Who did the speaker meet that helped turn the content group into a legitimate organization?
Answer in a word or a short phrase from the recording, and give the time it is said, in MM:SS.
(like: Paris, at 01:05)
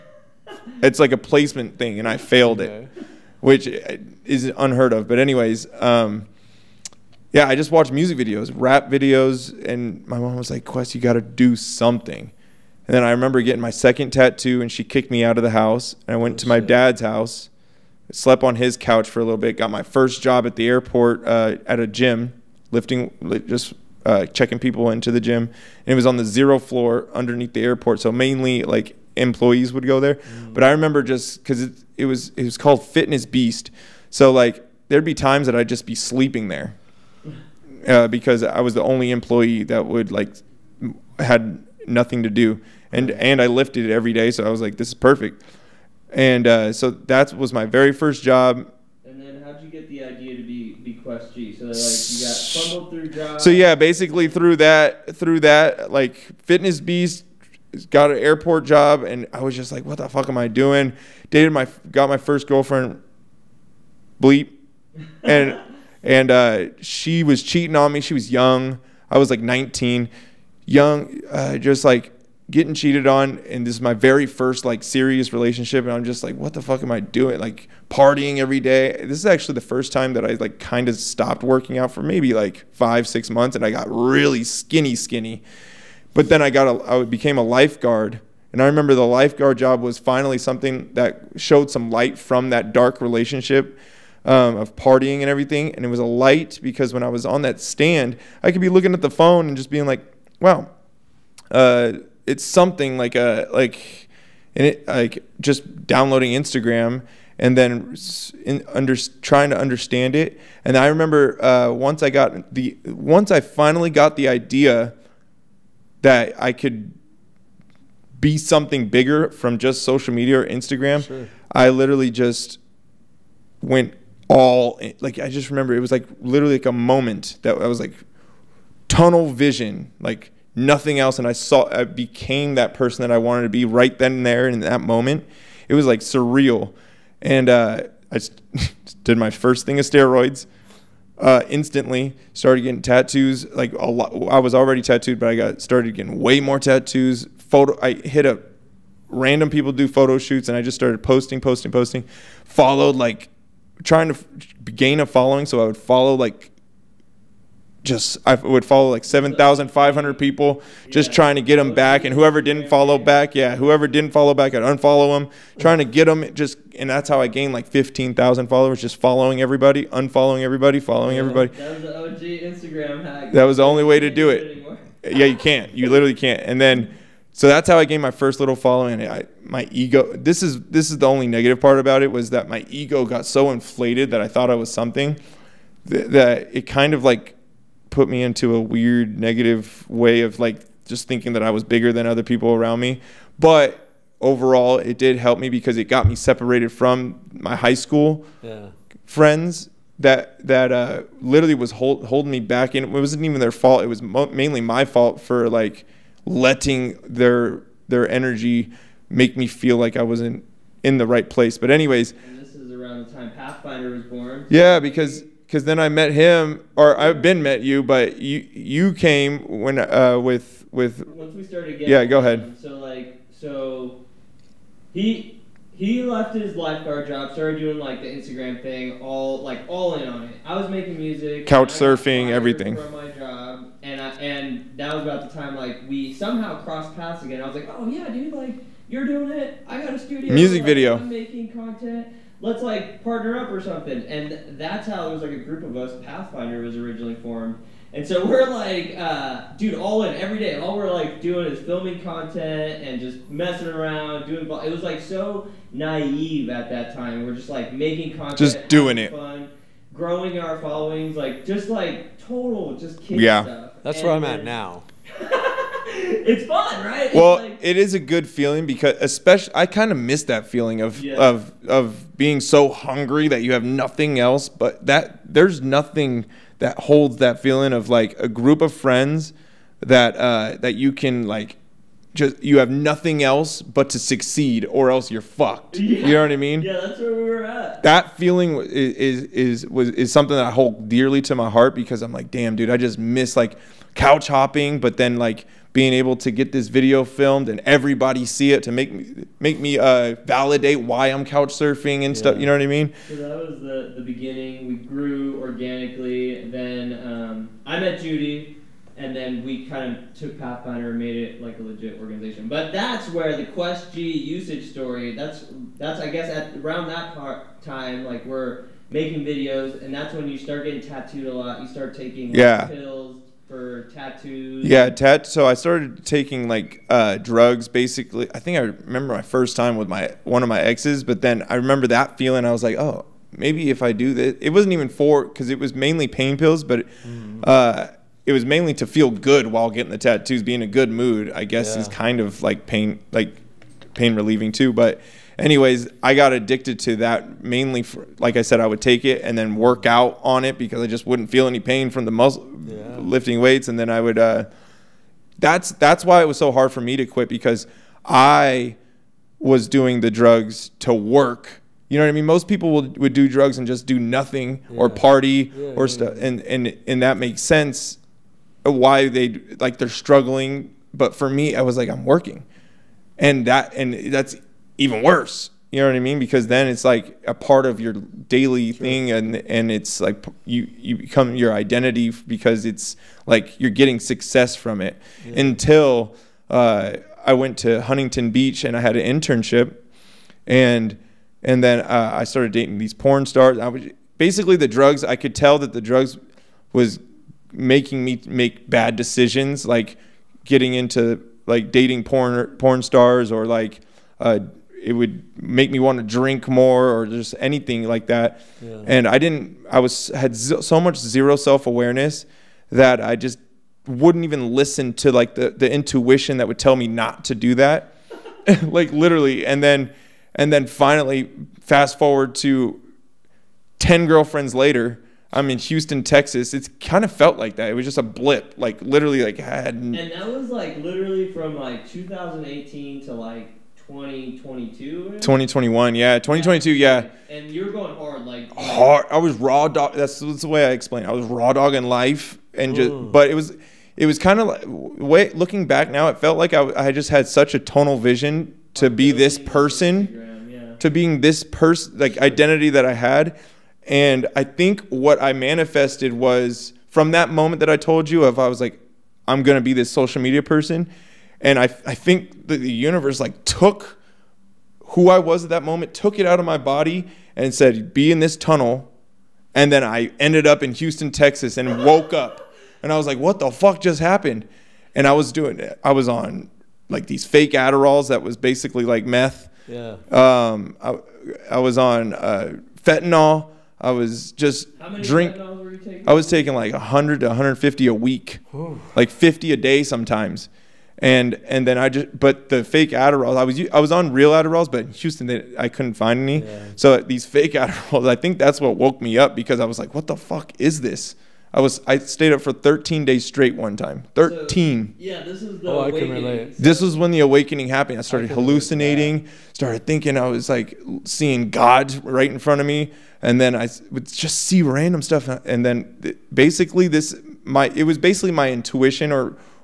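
Judy, at 05:08.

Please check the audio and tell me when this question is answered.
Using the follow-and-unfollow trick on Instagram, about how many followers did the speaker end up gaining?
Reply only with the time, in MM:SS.
02:47.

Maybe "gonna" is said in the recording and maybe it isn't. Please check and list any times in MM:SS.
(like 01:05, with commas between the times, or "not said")
07:39.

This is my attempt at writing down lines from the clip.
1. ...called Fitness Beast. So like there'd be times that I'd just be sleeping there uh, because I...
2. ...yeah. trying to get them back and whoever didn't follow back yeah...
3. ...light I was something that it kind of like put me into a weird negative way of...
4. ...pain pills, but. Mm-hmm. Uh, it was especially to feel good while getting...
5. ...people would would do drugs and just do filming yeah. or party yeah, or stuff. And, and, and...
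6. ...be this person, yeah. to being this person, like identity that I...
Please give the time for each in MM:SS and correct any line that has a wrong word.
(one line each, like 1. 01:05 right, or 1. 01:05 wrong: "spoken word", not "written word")
1. 00:32 right
2. 02:41 right
3. 03:04 wrong: "thought", not "light"
4. 05:36 wrong: "mainly", not "especially"
5. 06:02 wrong: "nothing", not "filming"
6. 07:28 right.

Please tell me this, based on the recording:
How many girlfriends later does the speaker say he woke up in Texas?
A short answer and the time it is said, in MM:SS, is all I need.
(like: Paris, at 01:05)
10, at 07:03.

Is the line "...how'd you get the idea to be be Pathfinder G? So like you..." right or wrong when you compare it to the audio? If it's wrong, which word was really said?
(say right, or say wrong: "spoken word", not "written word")
wrong: "Quest", not "Pathfinder".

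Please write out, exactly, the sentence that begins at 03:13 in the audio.
But overall, it did help me because it got me separated from my high school yeah.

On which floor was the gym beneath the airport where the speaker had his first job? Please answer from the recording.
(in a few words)
zero floor.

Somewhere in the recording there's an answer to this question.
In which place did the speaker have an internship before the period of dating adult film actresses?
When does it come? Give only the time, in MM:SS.
06:27.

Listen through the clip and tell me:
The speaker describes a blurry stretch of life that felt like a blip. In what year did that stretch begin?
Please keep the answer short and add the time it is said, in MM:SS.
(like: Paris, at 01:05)
2018, at 07:11.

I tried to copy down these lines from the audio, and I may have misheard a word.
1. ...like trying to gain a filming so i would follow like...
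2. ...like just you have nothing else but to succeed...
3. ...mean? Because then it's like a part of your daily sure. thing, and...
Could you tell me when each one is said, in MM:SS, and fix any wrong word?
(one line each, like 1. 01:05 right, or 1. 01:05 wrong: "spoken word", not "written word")
1. 02:32 wrong: "following", not "filming"
2. 04:41 right
3. 06:15 right.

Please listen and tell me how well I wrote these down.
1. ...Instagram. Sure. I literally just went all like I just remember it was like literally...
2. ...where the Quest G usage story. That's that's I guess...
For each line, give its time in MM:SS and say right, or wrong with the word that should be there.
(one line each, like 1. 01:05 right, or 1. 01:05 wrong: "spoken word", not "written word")
1. 02:00 right
2. 05:13 right.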